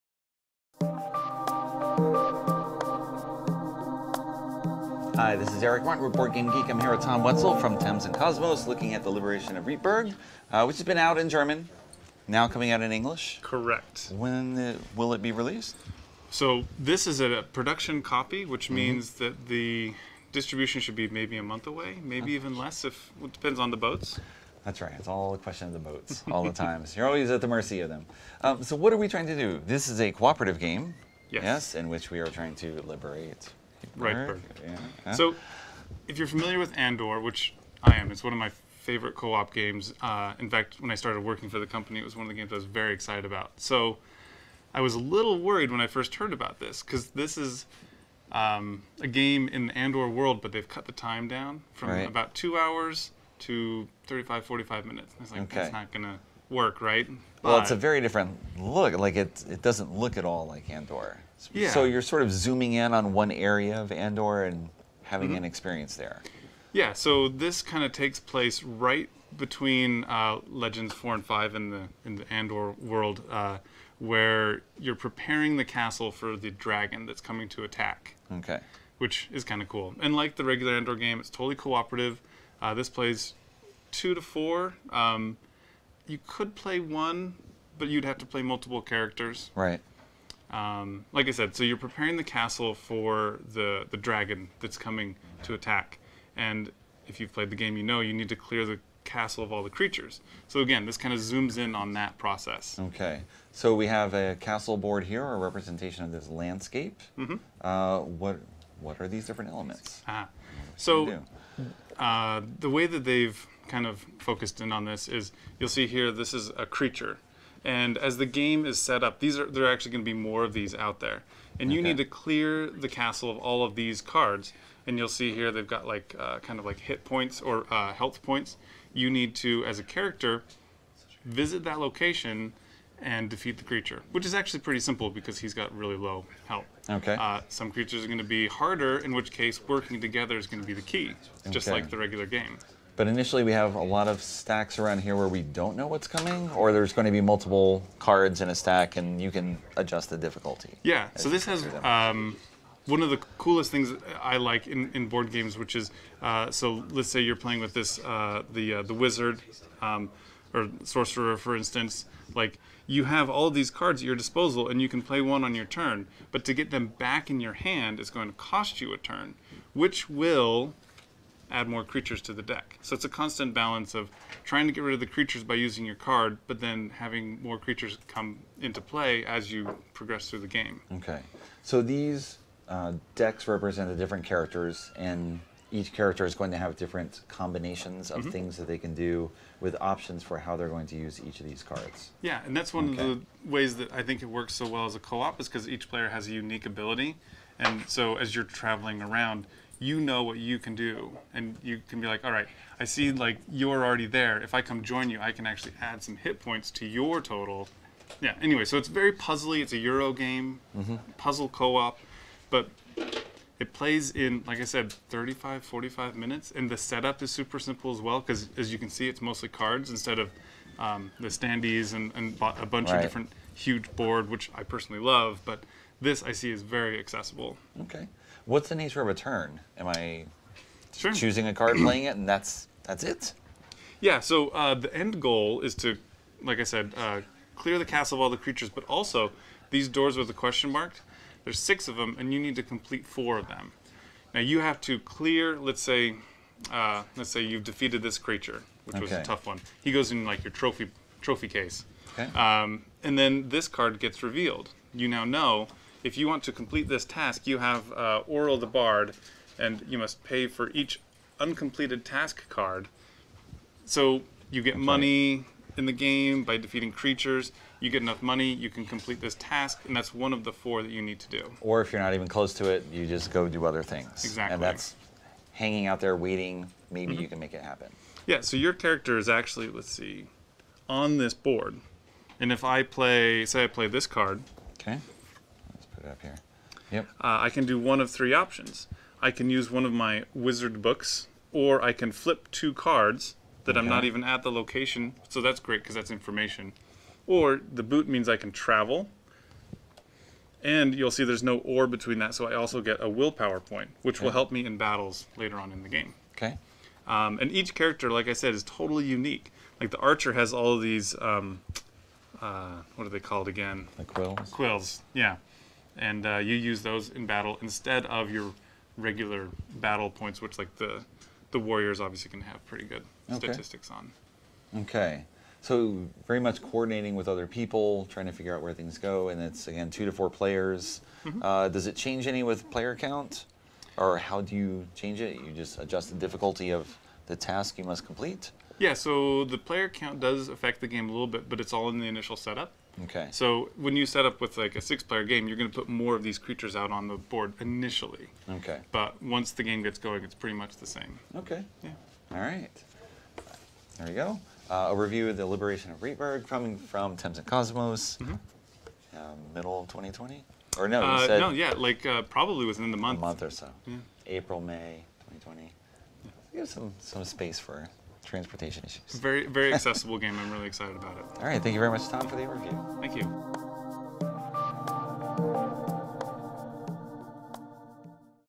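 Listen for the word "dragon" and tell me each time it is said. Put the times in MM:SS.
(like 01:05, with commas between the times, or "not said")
01:16, 01:33.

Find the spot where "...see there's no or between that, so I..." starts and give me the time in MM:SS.
05:01.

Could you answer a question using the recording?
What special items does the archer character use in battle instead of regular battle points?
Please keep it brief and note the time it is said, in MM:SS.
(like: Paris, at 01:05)
Quills, at 05:13.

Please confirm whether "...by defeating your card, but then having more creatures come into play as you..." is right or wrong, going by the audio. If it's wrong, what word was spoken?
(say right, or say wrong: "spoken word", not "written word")
wrong: "using", not "defeating".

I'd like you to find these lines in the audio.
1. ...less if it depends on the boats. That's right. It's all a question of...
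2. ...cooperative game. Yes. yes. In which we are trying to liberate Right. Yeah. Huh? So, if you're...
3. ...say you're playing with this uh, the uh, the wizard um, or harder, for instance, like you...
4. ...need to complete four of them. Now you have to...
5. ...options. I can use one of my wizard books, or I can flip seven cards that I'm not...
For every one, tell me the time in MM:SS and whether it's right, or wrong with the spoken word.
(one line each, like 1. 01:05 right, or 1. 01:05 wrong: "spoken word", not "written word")
1. 00:22 right
2. 00:30 right
3. 02:37 wrong: "sorcerer", not "harder"
4. 04:02 right
5. 04:48 wrong: "two", not "seven".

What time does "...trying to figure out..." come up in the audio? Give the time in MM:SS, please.
05:28.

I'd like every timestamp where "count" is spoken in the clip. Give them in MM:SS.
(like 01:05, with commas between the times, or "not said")
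05:32, 05:39.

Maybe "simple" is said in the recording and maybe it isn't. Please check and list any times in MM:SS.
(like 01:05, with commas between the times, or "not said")
02:14, 03:37.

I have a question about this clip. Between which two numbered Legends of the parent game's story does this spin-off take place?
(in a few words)
4 and 5.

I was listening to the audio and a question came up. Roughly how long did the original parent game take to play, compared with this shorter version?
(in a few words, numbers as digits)
About 2 hours.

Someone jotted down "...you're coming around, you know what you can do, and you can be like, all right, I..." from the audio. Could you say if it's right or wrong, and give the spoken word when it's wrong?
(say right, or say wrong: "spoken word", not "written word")
wrong: "traveling", not "coming".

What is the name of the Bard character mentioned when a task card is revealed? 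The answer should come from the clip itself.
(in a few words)
Oral.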